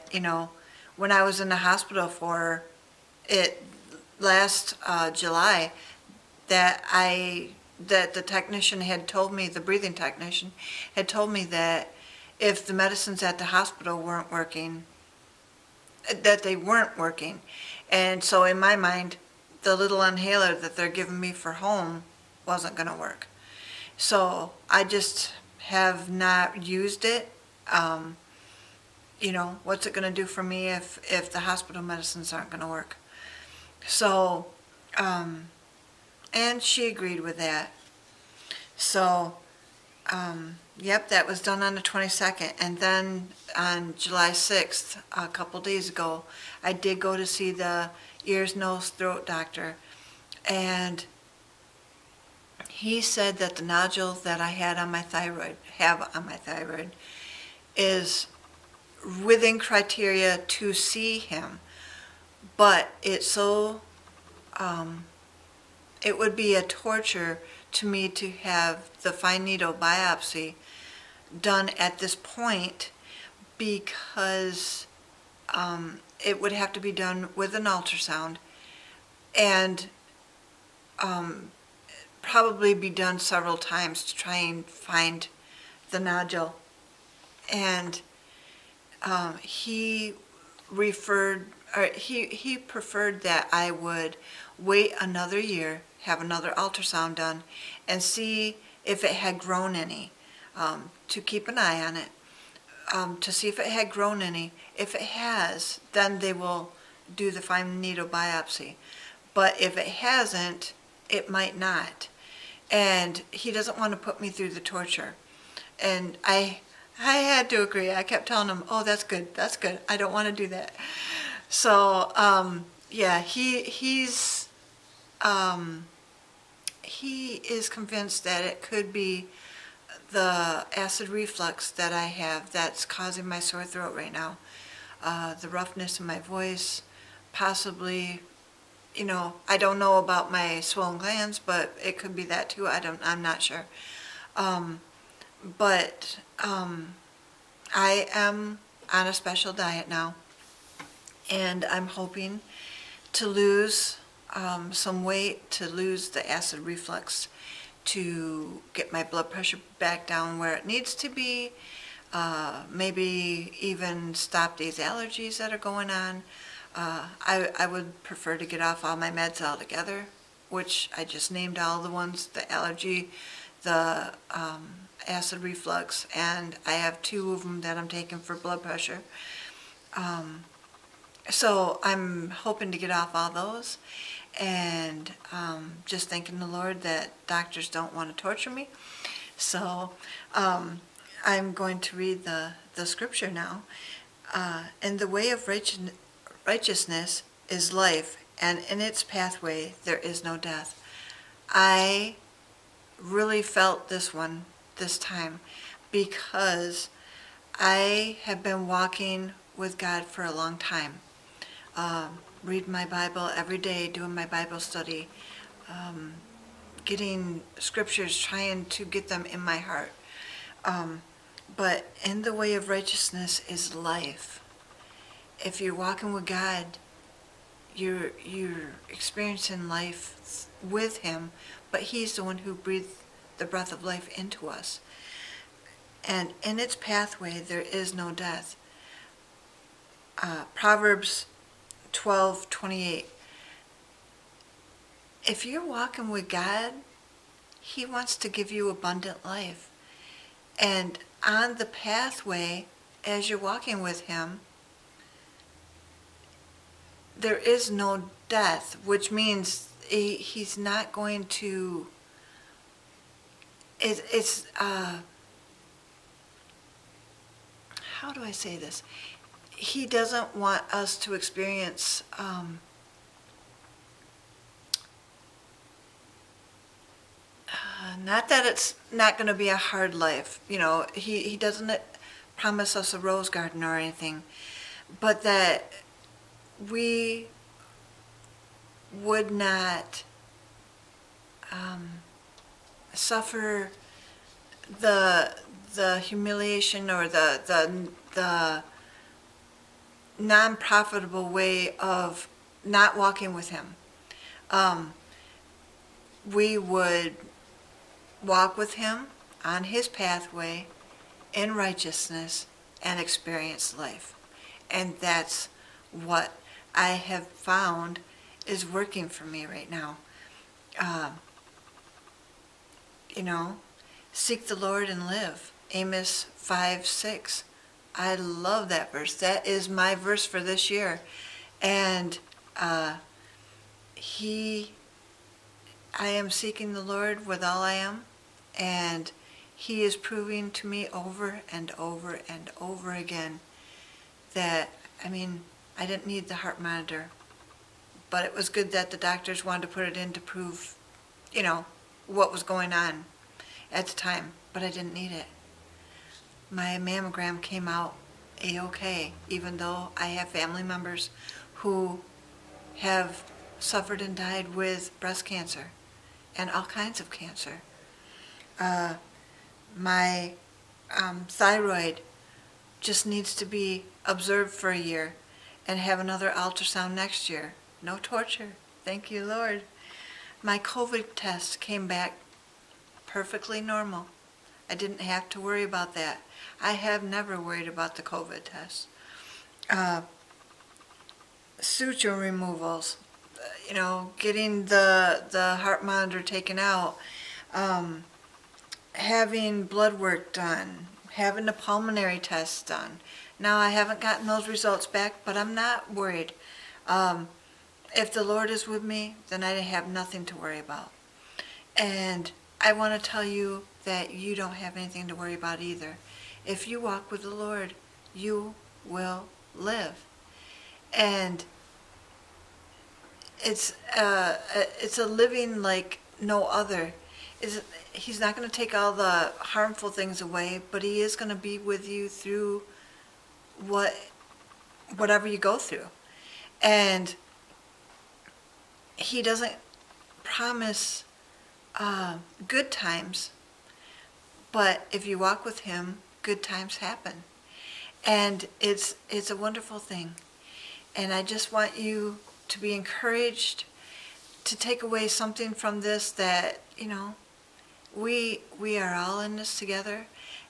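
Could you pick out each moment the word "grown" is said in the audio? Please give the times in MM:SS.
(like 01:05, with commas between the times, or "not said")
01:39, 01:43.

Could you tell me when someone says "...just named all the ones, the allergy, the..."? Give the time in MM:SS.
02:51.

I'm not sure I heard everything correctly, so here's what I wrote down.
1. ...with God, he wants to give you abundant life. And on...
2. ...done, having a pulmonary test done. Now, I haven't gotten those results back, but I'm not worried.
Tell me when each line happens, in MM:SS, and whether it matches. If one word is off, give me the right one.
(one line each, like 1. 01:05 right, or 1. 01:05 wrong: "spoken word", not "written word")
1. 04:06 right
2. 06:40 right.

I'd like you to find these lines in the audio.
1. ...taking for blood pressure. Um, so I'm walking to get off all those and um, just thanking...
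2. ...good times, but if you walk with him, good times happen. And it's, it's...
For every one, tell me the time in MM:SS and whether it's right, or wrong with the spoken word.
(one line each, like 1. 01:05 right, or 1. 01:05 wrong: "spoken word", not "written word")
1. 02:57 wrong: "hoping", not "walking"
2. 07:22 right.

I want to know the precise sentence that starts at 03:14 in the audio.
Uh, and the way of righteousness is life, and in its pathway there is no death.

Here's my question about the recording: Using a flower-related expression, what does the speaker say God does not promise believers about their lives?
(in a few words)
a rose garden.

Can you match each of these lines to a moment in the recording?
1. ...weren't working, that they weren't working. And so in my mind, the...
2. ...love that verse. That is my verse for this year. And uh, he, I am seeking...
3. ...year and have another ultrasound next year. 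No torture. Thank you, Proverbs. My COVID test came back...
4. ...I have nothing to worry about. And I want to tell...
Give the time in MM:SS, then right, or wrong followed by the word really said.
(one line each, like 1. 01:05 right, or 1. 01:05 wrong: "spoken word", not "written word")
1. 00:14 right
2. 05:28 right
3. 06:14 wrong: "Lord", not "Proverbs"
4. 06:49 right.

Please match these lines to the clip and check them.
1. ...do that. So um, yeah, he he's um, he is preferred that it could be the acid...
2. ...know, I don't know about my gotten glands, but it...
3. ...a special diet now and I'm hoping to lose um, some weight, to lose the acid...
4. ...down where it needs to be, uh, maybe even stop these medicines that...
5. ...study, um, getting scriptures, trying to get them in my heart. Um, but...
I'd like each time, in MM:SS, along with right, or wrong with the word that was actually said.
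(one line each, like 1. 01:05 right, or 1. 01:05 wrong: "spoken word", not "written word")
1. 02:00 wrong: "convinced", not "preferred"
2. 02:19 wrong: "swollen", not "gotten"
3. 02:29 right
4. 02:40 wrong: "allergies", not "medicines"
5. 03:34 right.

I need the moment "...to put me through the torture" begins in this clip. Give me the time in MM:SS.
01:53.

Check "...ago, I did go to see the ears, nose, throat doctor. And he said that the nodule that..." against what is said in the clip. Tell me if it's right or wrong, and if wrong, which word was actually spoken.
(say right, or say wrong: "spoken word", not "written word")
right.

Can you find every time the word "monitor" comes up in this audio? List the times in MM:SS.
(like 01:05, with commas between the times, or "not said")
05:46, 06:35.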